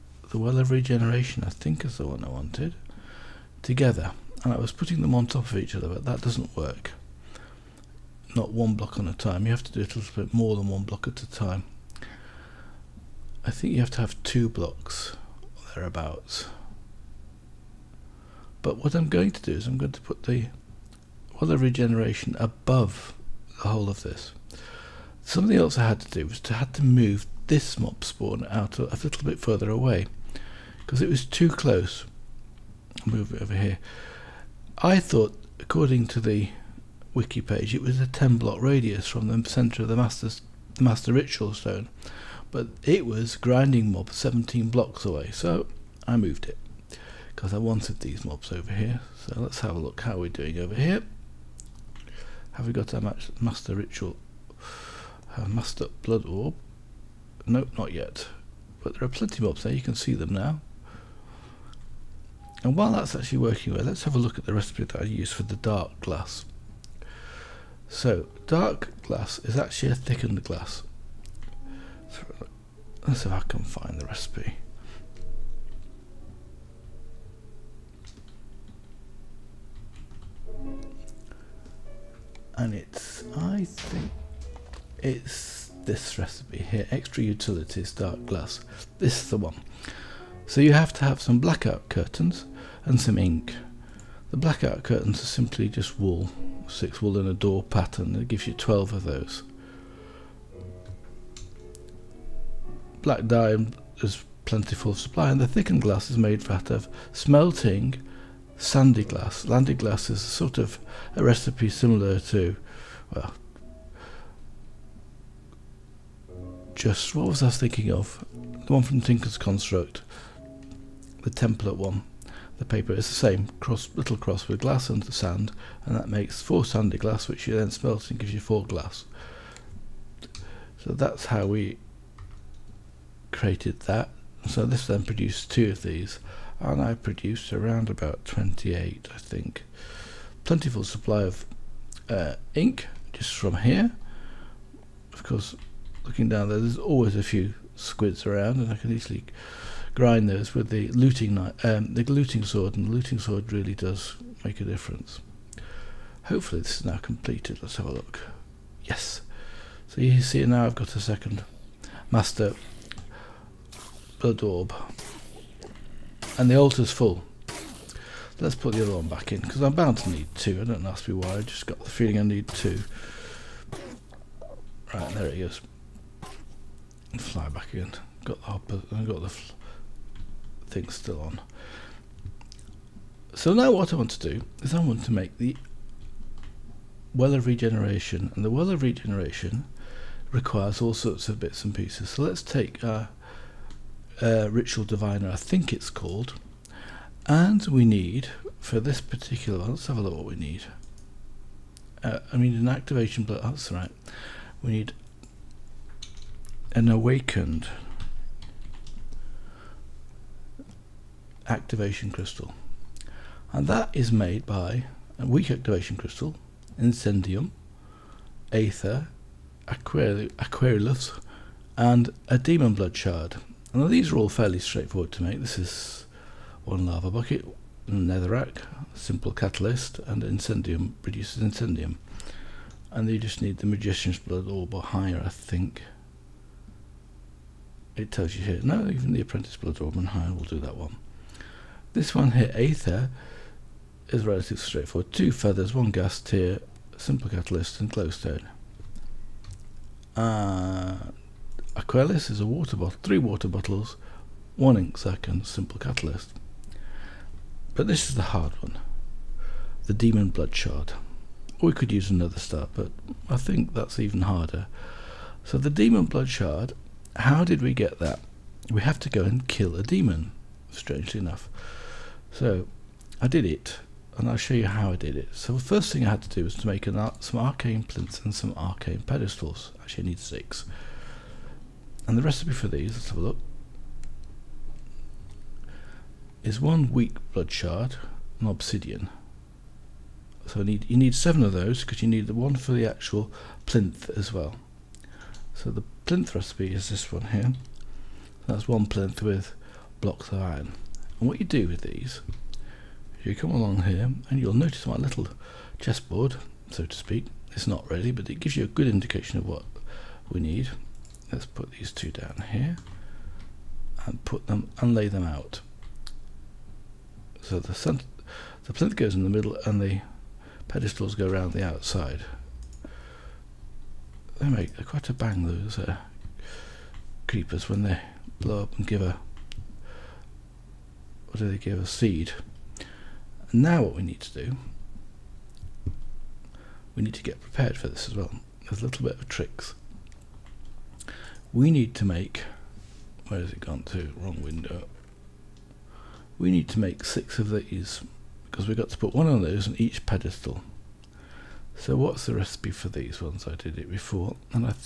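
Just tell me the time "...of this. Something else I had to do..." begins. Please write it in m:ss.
0:23.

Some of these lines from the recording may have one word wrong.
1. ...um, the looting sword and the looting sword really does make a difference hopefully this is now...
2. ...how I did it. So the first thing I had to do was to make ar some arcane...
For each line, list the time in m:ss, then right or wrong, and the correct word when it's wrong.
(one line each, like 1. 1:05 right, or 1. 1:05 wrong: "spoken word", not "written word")
1. 2:31 right
2. 4:34 right.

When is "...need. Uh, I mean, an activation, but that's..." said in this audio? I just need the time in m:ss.
3:20.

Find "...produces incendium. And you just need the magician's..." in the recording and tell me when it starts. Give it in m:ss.
3:51.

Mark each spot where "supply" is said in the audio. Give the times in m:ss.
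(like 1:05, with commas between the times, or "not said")
1:44, 2:20.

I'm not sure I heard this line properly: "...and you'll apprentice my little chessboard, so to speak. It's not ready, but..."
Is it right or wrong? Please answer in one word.
wrong.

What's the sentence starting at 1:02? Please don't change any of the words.
And while that's actually working well, let's have a look at the recipe that I use for the dark glass.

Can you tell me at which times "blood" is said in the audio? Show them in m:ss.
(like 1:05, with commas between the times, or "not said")
0:56, 2:44, 3:42, 3:54, 3:59, 4:20, 4:26, 4:47.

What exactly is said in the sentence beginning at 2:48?
Let's put the other one back in because I'm bound to need two.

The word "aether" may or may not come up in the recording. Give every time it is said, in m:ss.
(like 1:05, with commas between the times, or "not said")
3:38, 4:02.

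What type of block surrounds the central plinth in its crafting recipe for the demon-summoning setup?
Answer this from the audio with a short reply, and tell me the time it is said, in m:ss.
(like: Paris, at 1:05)
blocks of iron, at 5:00.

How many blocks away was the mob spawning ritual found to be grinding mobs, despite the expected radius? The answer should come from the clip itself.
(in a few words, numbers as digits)
17.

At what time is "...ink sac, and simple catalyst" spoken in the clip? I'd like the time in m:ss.
4:14.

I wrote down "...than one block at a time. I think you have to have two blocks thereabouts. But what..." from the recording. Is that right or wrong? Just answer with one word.
right.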